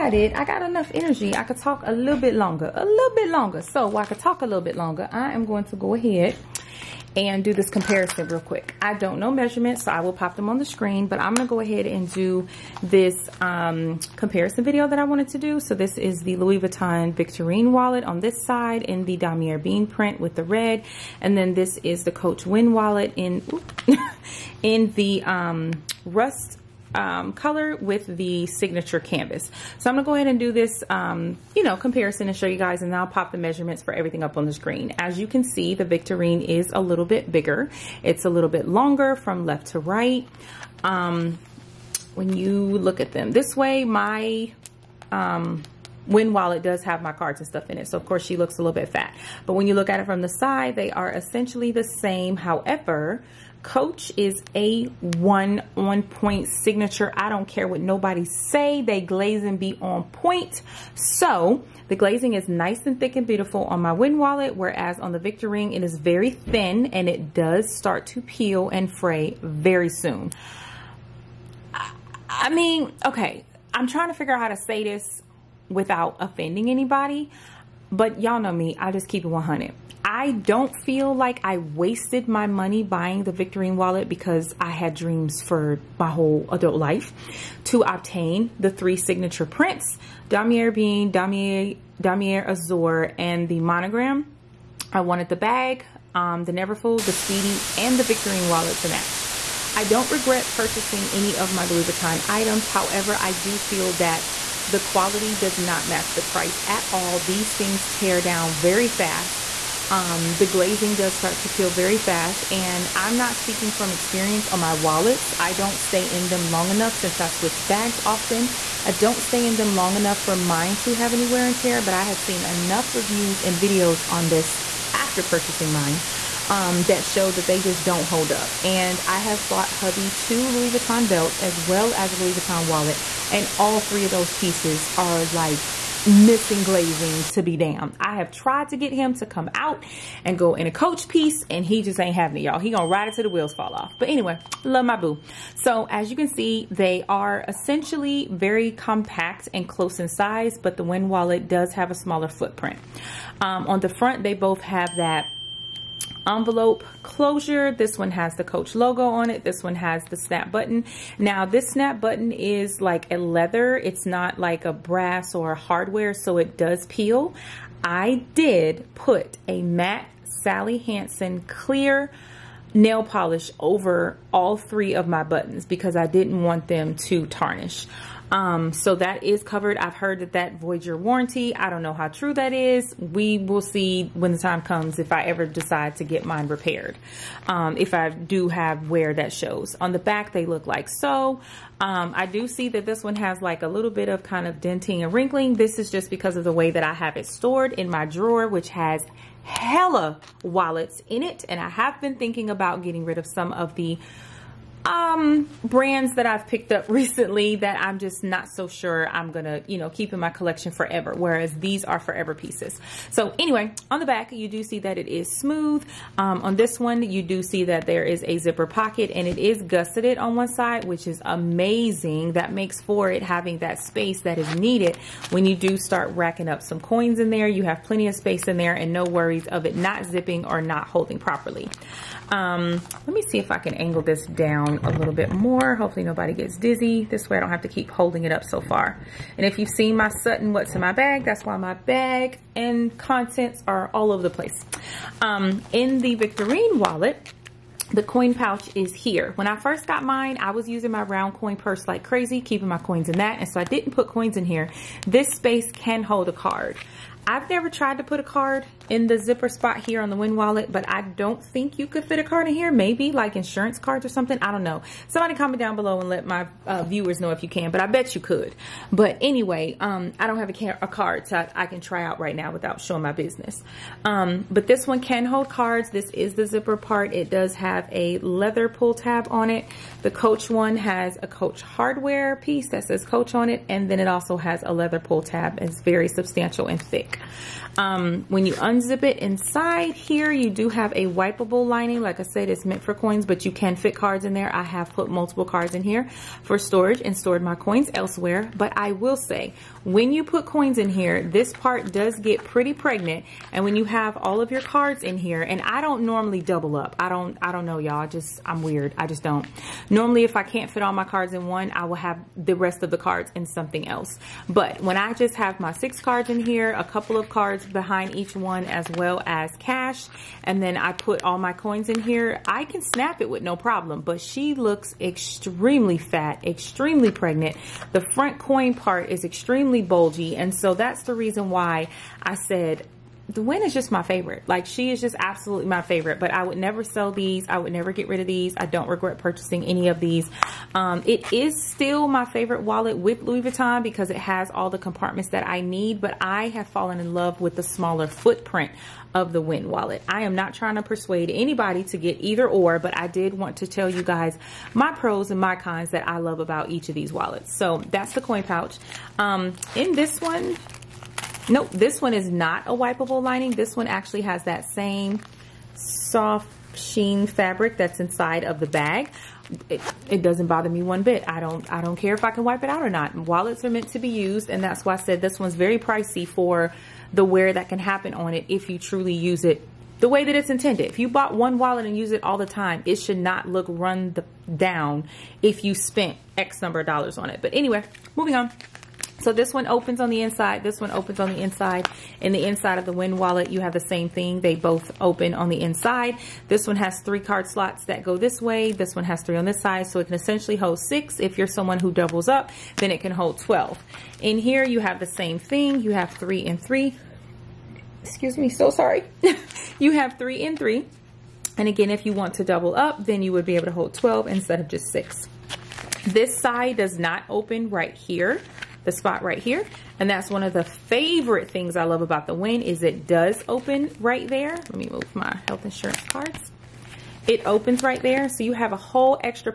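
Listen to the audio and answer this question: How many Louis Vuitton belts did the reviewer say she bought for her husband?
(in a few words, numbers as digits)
2.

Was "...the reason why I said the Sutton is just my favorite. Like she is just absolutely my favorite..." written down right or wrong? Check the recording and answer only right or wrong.
wrong.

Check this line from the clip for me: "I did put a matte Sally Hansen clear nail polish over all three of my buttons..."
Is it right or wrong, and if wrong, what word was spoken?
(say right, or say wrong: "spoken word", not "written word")
right.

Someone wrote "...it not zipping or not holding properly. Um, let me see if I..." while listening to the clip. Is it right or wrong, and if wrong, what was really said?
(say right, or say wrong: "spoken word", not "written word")
right.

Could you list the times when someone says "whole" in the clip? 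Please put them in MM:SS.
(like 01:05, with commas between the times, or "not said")
01:26, 07:08.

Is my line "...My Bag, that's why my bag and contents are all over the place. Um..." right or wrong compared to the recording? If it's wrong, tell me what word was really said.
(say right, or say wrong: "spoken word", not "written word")
right.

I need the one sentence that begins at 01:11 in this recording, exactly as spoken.
I, I mean, okay, I'm trying to figure out how to say this without offending anybody.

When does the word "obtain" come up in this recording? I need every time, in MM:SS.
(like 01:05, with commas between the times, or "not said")
01:27.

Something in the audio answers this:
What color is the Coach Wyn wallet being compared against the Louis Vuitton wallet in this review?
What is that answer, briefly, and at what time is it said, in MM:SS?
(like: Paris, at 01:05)
Rust, at 00:26.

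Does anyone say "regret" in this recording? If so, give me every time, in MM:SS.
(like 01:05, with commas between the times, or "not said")
01:40, 05:38.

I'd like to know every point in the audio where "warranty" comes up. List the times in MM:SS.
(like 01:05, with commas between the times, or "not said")
03:00.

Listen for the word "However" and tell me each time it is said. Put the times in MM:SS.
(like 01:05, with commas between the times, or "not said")
00:52, 01:42.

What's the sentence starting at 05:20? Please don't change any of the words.
And then I put all my coins in here.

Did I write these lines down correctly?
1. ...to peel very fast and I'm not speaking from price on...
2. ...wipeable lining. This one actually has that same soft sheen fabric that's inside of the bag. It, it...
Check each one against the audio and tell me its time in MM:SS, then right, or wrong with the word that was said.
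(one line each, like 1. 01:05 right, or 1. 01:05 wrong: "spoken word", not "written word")
1. 01:51 wrong: "experience", not "price"
2. 06:02 right.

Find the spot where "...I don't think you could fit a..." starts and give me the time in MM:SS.
04:20.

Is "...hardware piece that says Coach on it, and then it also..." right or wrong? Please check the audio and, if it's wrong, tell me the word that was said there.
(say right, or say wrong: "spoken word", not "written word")
right.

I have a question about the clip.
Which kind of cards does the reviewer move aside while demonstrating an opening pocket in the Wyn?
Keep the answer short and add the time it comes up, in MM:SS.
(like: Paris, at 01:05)
Health insurance cards, at 07:05.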